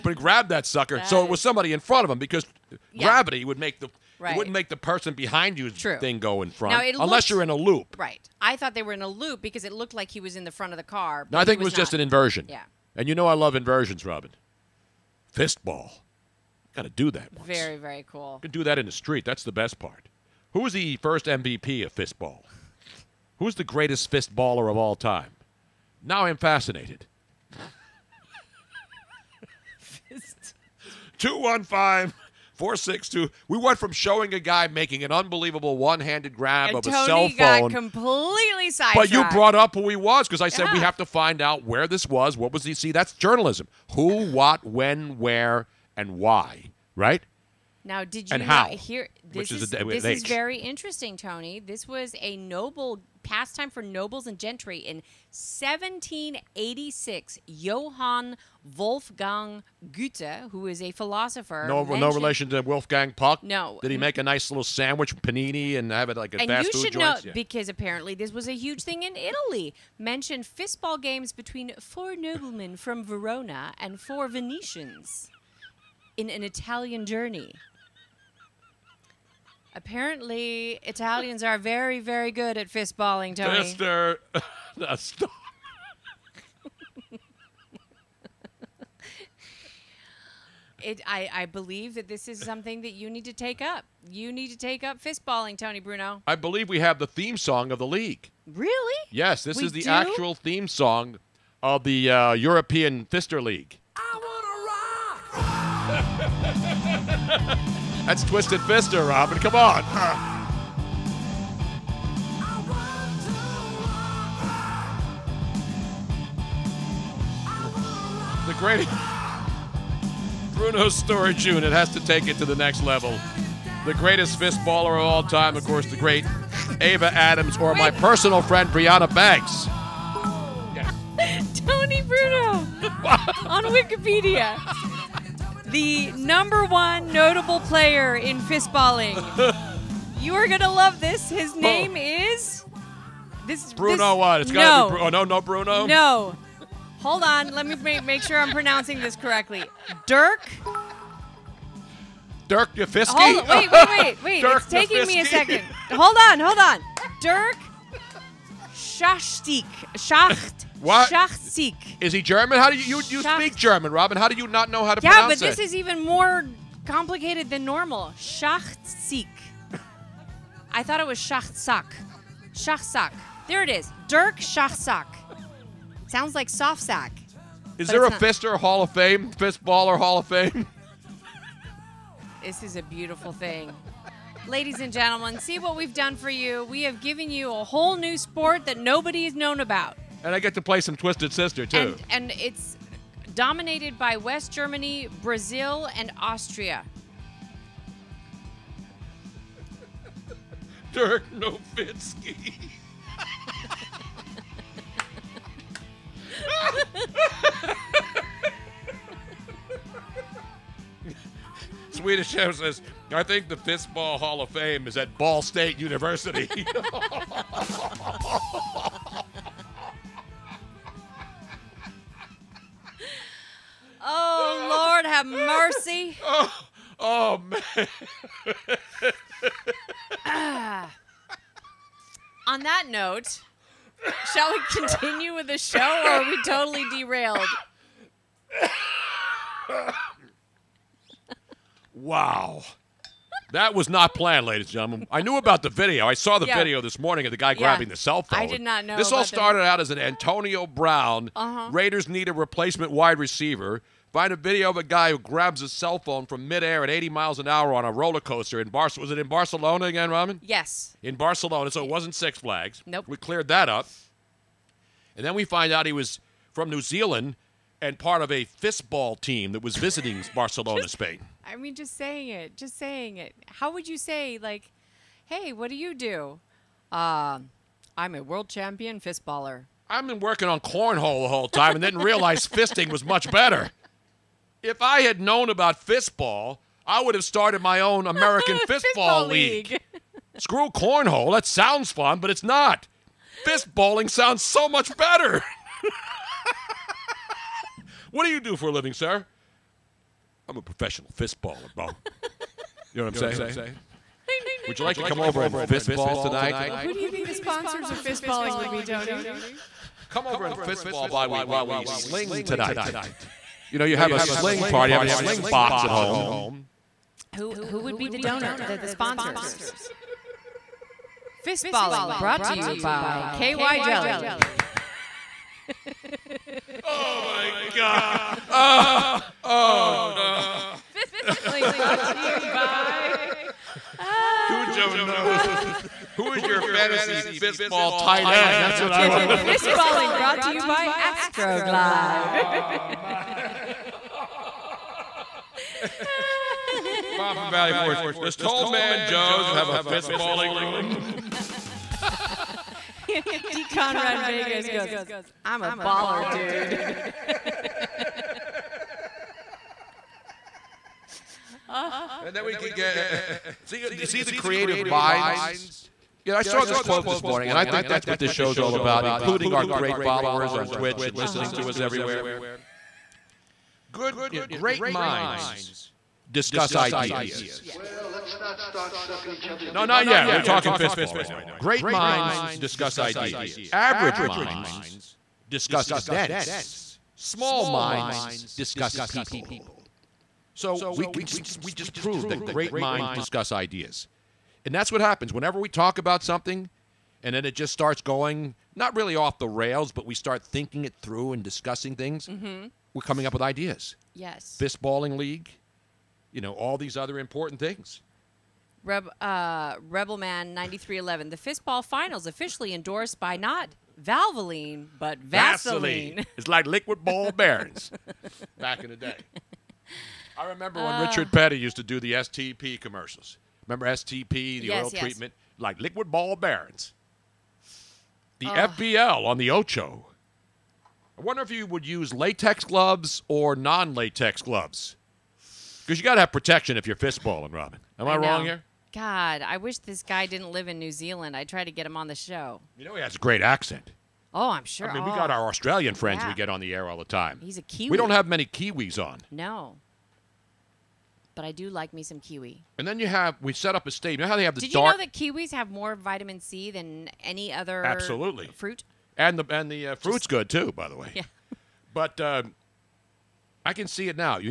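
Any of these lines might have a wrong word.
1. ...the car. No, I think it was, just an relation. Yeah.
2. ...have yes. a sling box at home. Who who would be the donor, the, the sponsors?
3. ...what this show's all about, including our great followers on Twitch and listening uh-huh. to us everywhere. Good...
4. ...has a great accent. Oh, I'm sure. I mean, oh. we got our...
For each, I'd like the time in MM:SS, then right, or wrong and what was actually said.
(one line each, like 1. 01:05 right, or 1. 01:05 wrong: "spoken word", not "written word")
1. 00:10 wrong: "inversion", not "relation"
2. 05:14 right
3. 06:08 right
4. 07:23 right.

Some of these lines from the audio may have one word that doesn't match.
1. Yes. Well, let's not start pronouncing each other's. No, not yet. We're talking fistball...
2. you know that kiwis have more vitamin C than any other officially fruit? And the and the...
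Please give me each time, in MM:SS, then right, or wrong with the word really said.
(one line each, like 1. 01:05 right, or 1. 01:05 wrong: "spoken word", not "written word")
1. 06:17 wrong: "sucking", not "pronouncing"
2. 07:34 wrong: "absolutely", not "officially".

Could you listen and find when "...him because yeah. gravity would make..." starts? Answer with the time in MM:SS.
00:02.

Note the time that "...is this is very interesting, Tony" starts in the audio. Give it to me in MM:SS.
00:49.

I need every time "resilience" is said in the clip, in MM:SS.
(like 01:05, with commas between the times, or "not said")
not said.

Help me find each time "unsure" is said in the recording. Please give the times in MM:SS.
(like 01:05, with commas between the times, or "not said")
not said.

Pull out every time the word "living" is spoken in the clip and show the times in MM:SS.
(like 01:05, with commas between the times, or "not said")
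04:58.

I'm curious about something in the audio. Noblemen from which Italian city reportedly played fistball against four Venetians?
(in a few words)
Verona.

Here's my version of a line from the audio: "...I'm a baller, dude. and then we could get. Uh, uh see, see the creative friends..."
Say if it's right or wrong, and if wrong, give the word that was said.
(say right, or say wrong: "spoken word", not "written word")
wrong: "minds", not "friends".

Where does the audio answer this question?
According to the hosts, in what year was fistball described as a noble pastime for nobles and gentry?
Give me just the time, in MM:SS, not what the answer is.
00:55.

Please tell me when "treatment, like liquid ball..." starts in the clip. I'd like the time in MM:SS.
07:05.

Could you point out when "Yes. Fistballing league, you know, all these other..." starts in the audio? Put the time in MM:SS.
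06:44.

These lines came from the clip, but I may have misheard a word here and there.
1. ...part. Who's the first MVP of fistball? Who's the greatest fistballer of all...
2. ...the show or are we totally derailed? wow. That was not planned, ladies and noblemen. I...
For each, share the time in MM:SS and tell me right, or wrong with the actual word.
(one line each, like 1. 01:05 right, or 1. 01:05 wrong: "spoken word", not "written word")
1. 00:19 right
2. 03:55 wrong: "gentlemen", not "noblemen".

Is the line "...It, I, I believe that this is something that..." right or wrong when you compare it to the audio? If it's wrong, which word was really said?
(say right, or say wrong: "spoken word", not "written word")
right.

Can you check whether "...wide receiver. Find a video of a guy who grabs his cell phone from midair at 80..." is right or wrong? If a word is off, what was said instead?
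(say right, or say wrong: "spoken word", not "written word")
right.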